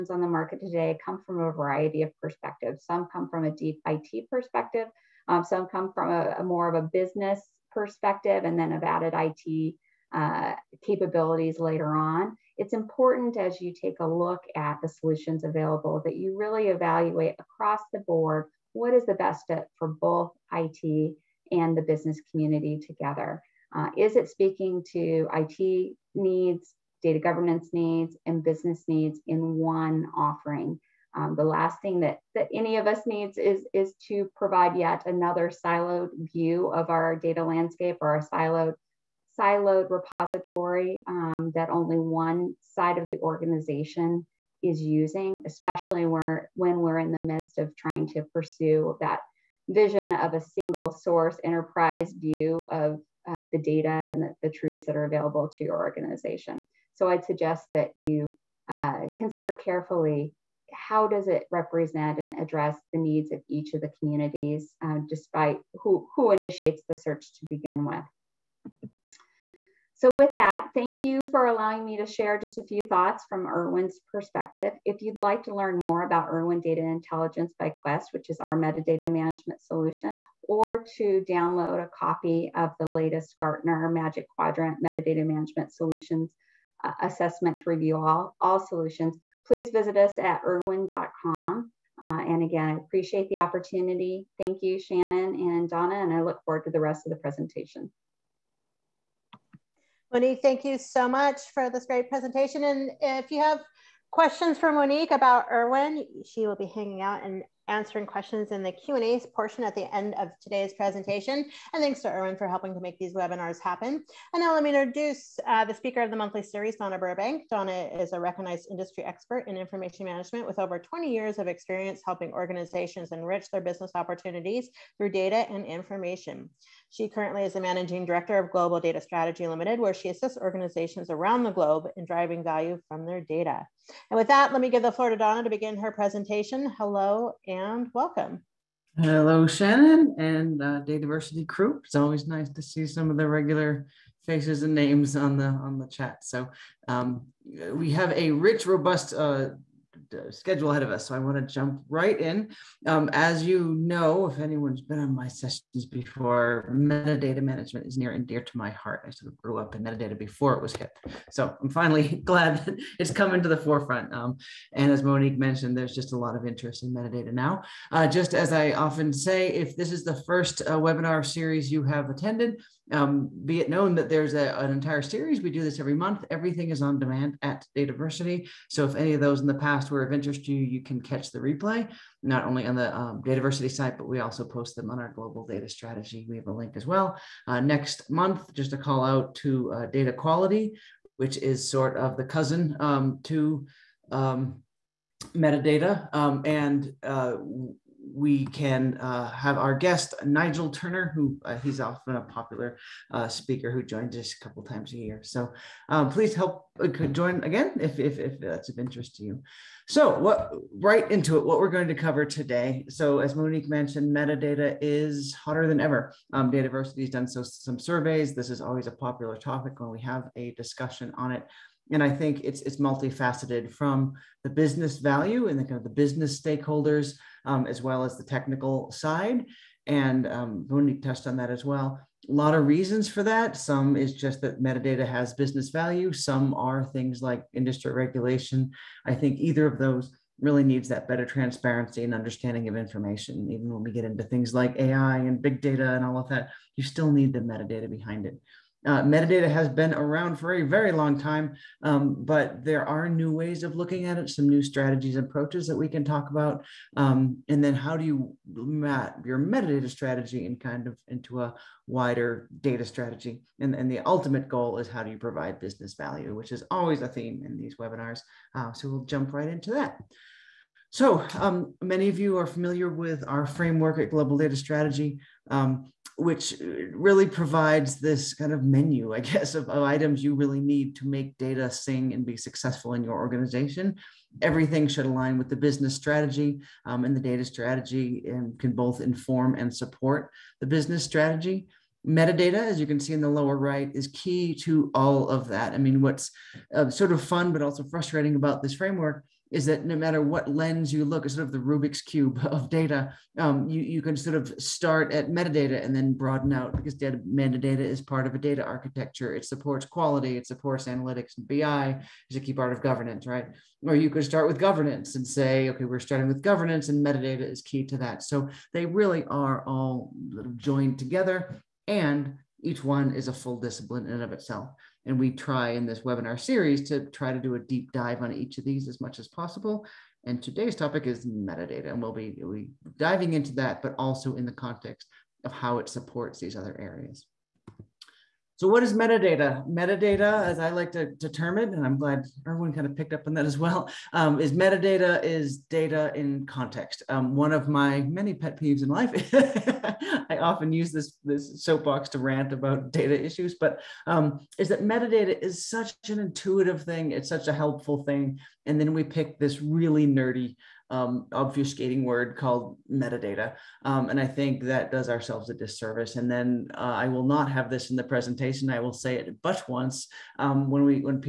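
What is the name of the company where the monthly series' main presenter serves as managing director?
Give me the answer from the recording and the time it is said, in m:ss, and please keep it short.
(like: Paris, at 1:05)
Global Data Strategy Limited, at 2:08.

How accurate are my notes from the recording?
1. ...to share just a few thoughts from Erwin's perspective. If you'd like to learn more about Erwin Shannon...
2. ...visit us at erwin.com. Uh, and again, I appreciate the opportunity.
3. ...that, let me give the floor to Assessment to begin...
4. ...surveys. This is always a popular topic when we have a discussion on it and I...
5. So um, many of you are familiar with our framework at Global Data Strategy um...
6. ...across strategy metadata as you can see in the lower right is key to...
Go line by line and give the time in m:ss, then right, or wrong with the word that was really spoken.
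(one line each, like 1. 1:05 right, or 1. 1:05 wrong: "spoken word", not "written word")
1. 1:11 wrong: "Data", not "Shannon"
2. 1:29 right
3. 2:14 wrong: "Donna", not "Assessment"
4. 3:37 right
5. 4:30 right
6. 4:50 wrong: "business", not "across".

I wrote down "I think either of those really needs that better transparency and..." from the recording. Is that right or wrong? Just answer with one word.
right.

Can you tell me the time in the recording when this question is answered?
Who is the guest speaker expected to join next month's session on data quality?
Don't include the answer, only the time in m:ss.
3:20.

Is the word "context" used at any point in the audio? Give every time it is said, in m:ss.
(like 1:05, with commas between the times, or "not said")
5:34, 5:46.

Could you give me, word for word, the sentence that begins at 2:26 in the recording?
So um, we have a rich, robust uh, uh, schedule ahead of us, so I want to jump right in.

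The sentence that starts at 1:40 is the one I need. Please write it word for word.
Monique, thank you so much for this great presentation.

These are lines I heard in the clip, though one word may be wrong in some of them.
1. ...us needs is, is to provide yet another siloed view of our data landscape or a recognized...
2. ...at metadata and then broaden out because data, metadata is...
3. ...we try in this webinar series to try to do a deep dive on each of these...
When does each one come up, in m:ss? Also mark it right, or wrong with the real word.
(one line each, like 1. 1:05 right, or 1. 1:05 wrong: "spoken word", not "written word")
1. 0:32 wrong: "siloed", not "recognized"
2. 5:05 right
3. 5:25 right.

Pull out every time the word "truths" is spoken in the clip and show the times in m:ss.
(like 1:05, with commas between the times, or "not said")
0:54.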